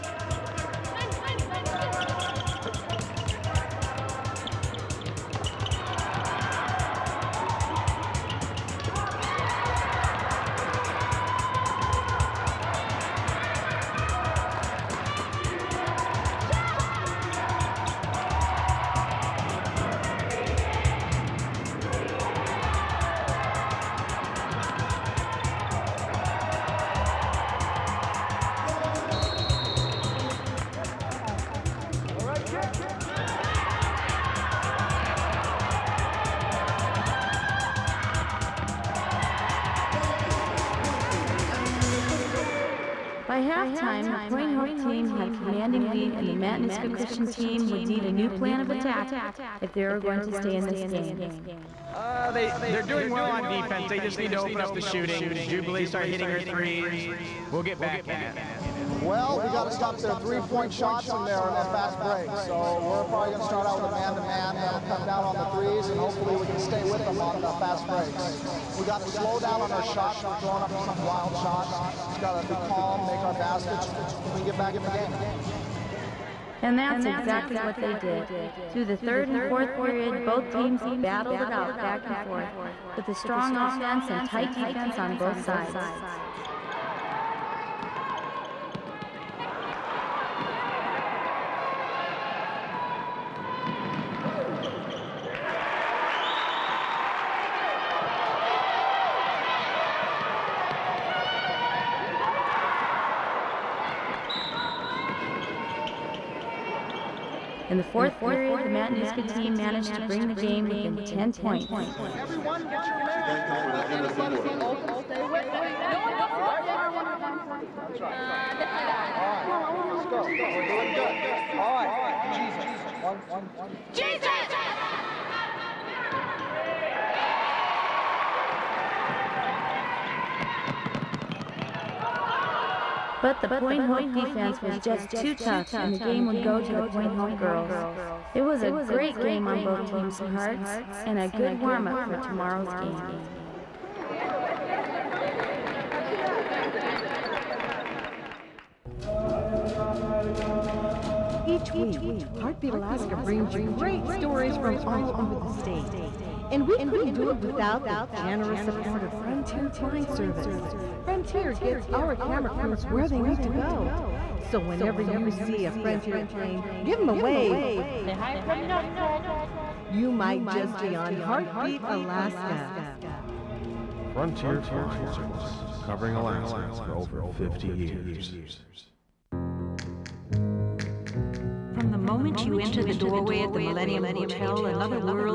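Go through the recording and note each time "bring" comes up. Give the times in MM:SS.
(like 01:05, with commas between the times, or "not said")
01:50, 02:33.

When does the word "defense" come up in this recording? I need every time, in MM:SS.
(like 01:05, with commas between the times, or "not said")
00:53, 01:24, 02:14.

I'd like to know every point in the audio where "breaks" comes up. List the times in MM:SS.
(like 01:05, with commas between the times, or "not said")
01:02, 01:07.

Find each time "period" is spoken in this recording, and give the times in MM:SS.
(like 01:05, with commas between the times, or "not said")
01:19, 01:48.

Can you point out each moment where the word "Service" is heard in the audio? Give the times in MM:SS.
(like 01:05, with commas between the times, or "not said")
02:40, 02:55.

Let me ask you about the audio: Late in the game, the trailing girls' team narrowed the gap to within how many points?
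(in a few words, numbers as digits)
10.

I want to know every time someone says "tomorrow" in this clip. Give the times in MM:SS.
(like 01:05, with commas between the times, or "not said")
01:56, 02:22.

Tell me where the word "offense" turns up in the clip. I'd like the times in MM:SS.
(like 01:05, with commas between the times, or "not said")
01:23.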